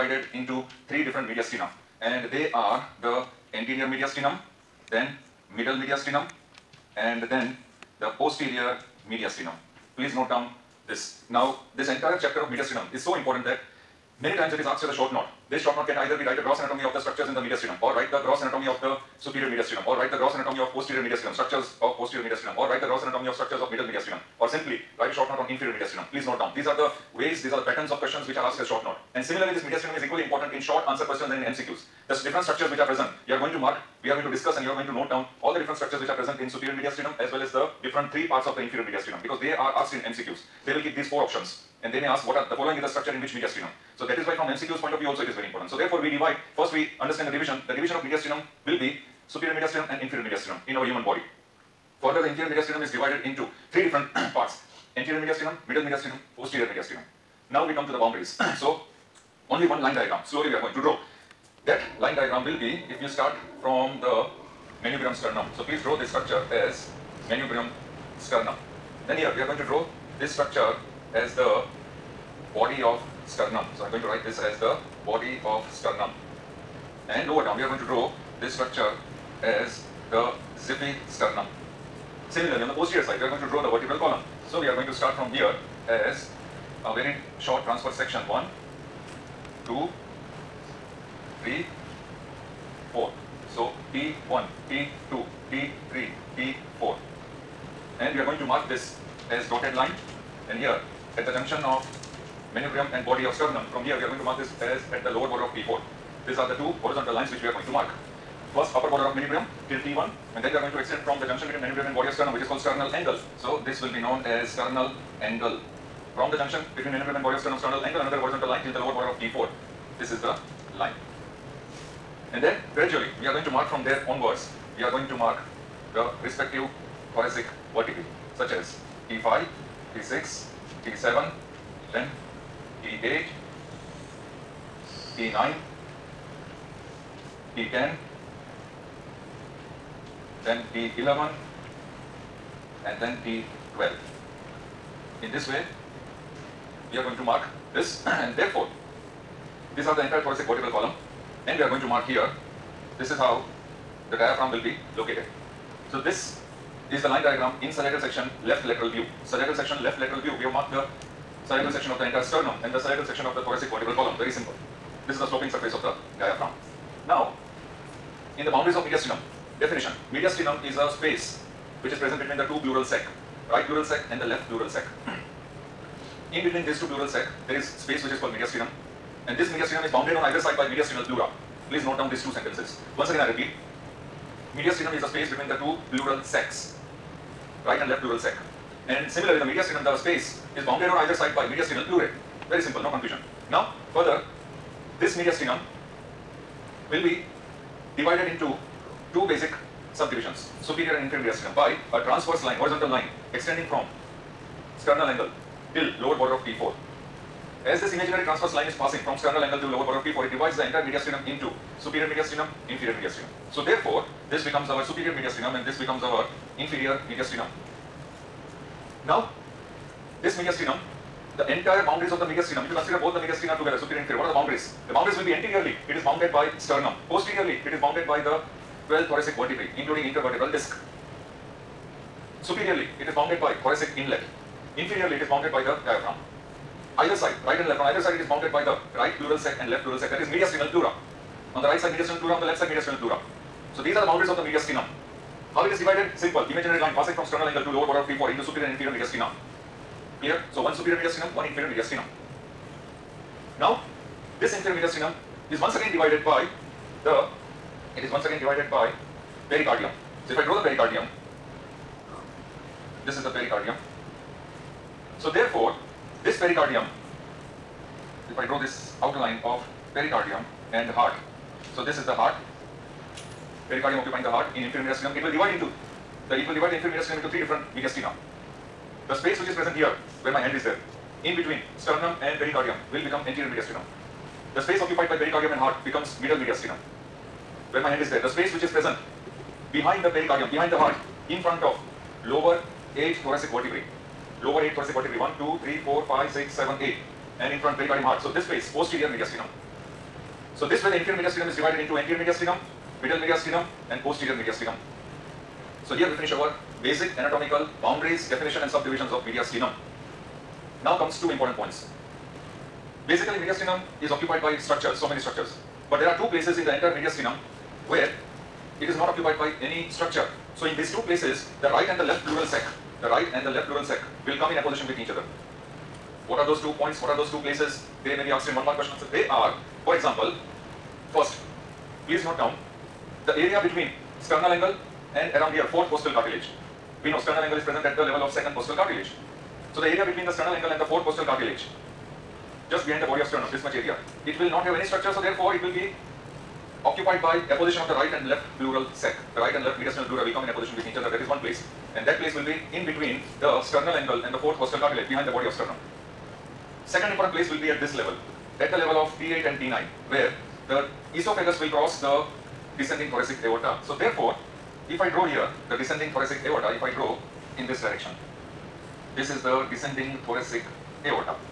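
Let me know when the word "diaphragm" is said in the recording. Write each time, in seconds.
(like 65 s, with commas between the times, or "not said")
154 s, 166 s, 235 s.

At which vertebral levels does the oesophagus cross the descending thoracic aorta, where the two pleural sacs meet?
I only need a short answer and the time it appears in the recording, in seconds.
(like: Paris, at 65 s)
D8 and D9, at 359 s.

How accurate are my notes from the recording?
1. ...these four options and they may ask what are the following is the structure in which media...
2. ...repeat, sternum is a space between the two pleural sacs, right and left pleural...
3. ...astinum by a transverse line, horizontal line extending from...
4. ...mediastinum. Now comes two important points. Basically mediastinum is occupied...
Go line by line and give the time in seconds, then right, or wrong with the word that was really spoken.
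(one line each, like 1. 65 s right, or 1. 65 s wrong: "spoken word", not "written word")
1. 40 s right
2. 183 s wrong: "mediastinum", not "sternum"
3. 201 s right
4. 309 s right.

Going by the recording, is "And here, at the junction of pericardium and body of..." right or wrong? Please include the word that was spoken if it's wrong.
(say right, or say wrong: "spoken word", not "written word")
wrong: "manubrium", not "pericardium".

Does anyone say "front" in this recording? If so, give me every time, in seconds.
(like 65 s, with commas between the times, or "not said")
291 s, 297 s.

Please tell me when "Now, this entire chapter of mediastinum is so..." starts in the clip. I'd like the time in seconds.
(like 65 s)
11 s.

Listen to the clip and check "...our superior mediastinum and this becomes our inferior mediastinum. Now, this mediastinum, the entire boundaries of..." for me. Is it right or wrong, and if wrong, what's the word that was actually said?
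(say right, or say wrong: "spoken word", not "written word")
right.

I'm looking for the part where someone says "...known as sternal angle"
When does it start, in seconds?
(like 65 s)
113 s.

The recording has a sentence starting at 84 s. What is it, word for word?
So we are going to start from here as a very short transverse section.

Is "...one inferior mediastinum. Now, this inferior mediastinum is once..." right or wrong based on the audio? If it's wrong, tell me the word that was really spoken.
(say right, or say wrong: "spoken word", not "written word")
right.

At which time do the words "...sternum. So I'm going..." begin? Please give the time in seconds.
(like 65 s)
73 s.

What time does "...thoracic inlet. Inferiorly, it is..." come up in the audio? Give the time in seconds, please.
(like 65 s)
233 s.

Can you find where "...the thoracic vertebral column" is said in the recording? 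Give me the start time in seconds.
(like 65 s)
163 s.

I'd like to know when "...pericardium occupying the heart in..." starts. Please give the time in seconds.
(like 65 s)
273 s.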